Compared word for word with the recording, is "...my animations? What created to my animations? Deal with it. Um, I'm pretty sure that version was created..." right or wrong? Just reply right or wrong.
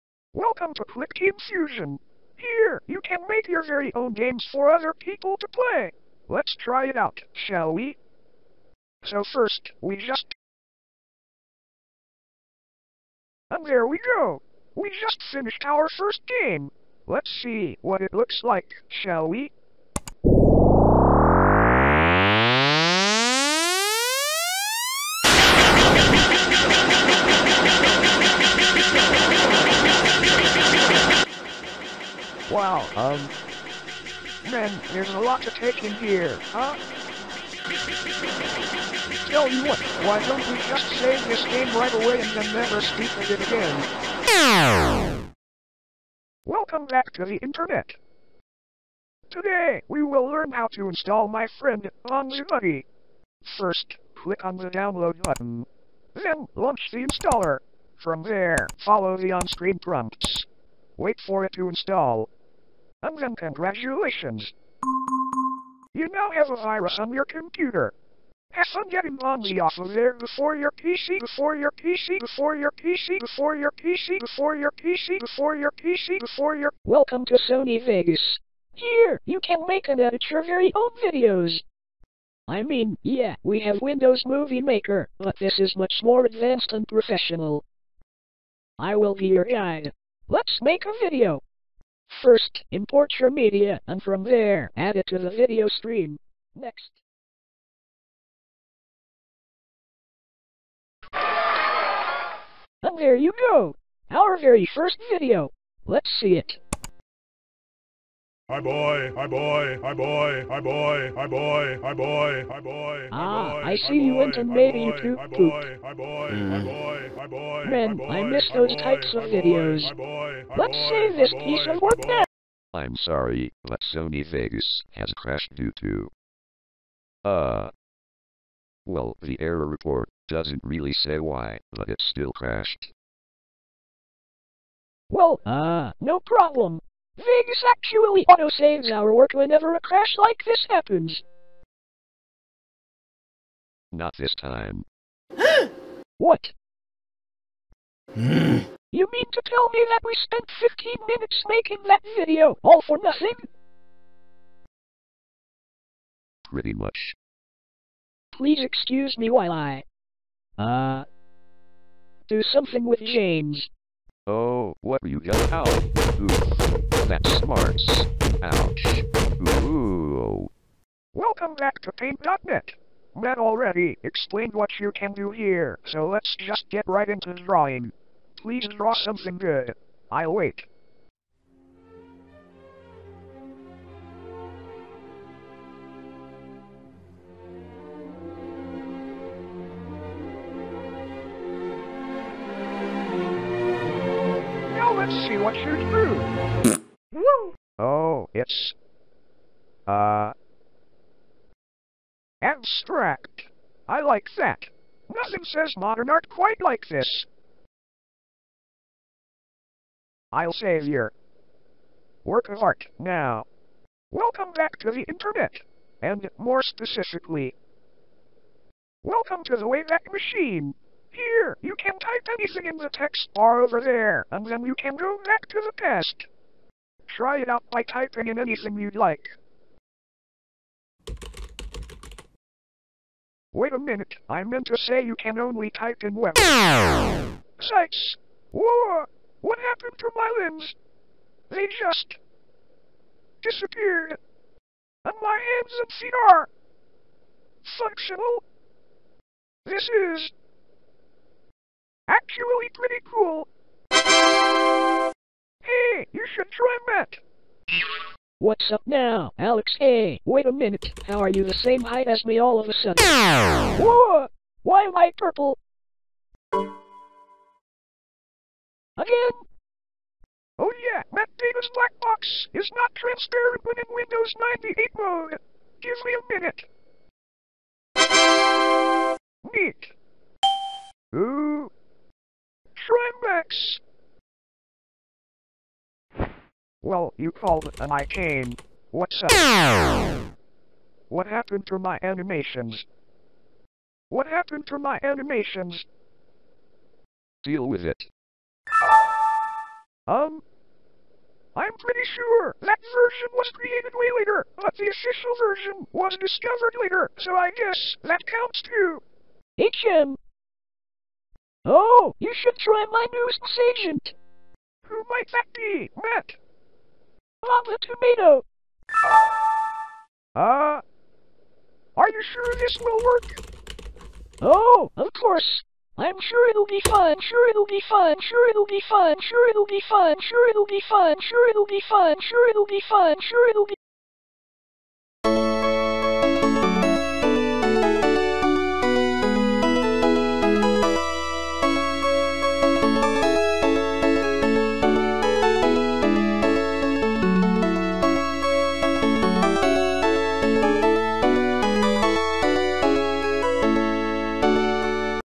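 wrong.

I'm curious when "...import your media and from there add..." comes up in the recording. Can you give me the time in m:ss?
1:32.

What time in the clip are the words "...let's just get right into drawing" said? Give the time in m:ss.
2:56.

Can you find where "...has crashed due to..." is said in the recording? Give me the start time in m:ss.
2:04.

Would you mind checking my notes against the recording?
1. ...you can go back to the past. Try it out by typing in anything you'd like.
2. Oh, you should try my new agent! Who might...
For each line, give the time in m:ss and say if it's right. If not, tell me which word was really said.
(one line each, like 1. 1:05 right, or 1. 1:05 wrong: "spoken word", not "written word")
1. 3:44 right
2. 5:11 right.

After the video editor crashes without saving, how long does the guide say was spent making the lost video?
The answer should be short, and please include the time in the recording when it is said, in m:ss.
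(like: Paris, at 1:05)
15 minutes, at 2:30.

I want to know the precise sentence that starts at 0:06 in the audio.
Let's try it out, shall we?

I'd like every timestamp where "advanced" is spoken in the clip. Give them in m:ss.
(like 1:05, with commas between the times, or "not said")
1:26.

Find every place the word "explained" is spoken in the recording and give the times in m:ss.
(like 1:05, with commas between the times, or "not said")
2:54.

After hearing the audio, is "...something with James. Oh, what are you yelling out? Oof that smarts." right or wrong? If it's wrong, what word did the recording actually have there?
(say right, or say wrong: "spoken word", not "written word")
right.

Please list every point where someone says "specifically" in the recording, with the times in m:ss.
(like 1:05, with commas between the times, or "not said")
3:36.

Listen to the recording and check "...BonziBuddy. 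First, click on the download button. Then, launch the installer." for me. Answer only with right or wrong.
right.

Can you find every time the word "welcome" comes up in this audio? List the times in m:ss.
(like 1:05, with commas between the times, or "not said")
0:00, 0:46, 1:16, 2:51, 3:34, 3:39.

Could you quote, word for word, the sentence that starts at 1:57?
Man, I miss those types of videos.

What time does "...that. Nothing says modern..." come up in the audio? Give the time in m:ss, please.
3:24.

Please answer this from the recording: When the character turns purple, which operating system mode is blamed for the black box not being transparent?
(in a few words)
Windows 98.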